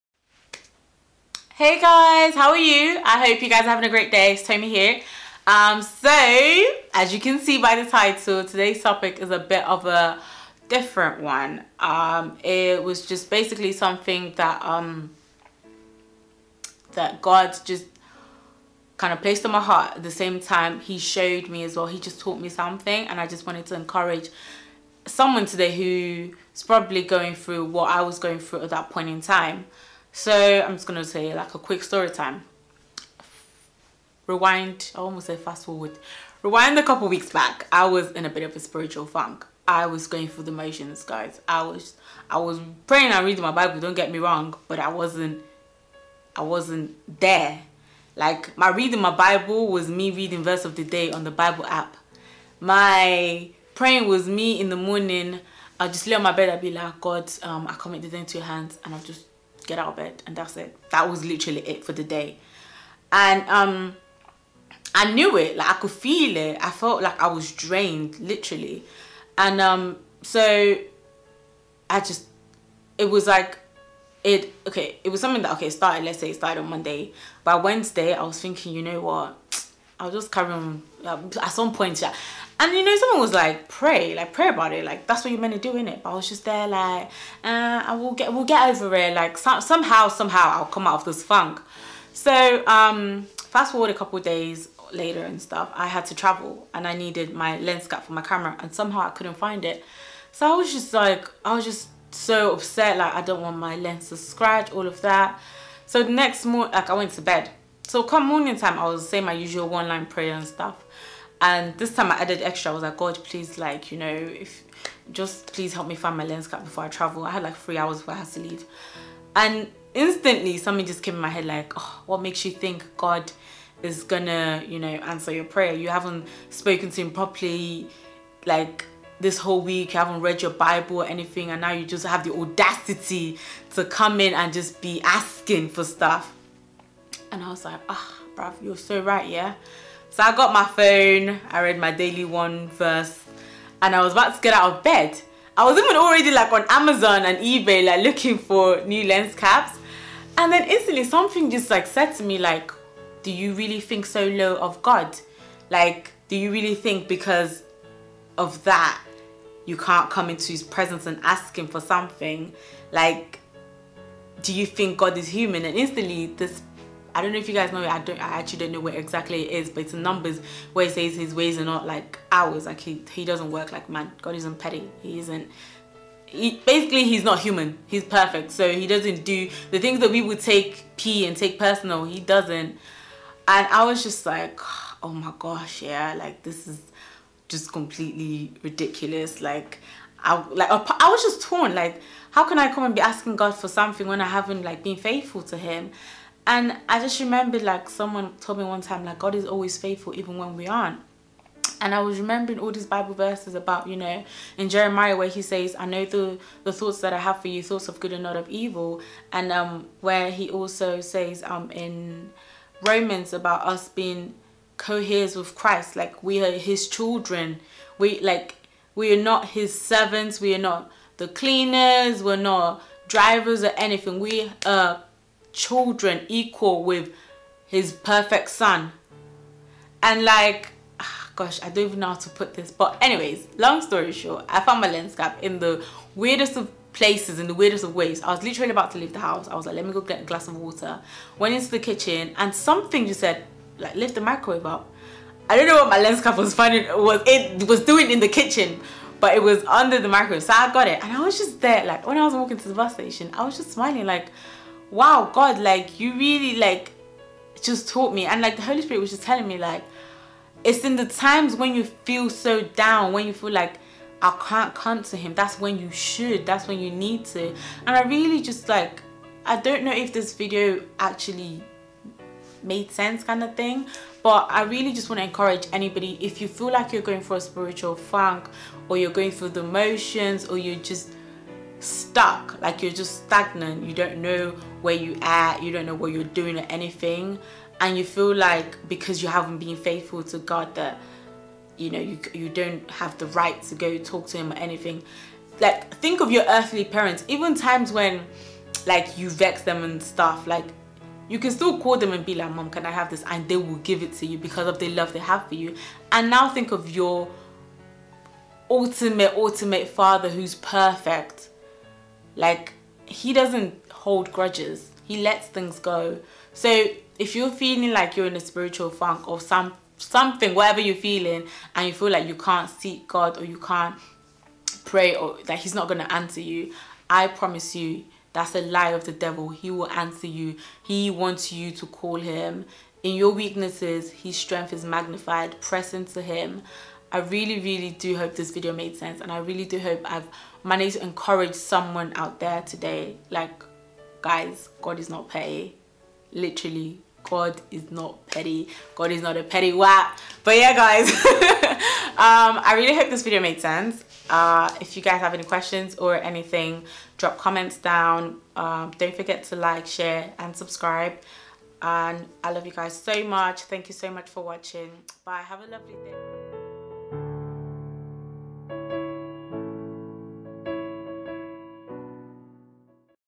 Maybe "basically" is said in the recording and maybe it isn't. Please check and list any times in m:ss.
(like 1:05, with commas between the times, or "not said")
0:13, 2:56.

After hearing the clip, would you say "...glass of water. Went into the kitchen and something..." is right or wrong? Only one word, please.
right.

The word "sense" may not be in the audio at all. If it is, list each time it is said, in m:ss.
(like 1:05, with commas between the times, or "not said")
4:32, 5:38, 5:53.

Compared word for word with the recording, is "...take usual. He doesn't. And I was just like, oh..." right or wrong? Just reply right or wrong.
wrong.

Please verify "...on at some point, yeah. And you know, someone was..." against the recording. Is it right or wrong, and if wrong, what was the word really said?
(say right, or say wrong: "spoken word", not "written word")
right.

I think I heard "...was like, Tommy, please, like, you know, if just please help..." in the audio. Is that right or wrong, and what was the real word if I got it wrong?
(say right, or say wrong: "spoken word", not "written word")
wrong: "God", not "Tommy".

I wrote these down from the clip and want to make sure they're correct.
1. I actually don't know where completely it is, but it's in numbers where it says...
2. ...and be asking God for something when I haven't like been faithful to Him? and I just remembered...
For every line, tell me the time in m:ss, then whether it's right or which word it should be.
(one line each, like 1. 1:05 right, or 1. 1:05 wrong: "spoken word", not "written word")
1. 2:48 wrong: "exactly", not "completely"
2. 3:12 right.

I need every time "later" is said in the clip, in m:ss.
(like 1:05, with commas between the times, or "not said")
1:34.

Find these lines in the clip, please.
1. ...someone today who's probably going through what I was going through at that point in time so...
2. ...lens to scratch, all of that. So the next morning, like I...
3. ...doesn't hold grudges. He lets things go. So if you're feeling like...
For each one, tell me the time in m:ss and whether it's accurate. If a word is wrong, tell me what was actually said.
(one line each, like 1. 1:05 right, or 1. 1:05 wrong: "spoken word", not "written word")
1. 0:25 right
2. 1:43 right
3. 5:13 right.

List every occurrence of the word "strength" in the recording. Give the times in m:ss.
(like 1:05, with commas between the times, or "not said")
5:34.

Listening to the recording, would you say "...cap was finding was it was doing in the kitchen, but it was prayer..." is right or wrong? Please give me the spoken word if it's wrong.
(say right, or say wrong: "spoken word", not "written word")
wrong: "under", not "prayer".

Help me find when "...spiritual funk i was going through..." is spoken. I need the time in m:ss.
0:38.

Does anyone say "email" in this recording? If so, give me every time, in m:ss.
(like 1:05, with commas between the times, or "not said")
not said.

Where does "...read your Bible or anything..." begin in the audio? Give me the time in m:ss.
2:10.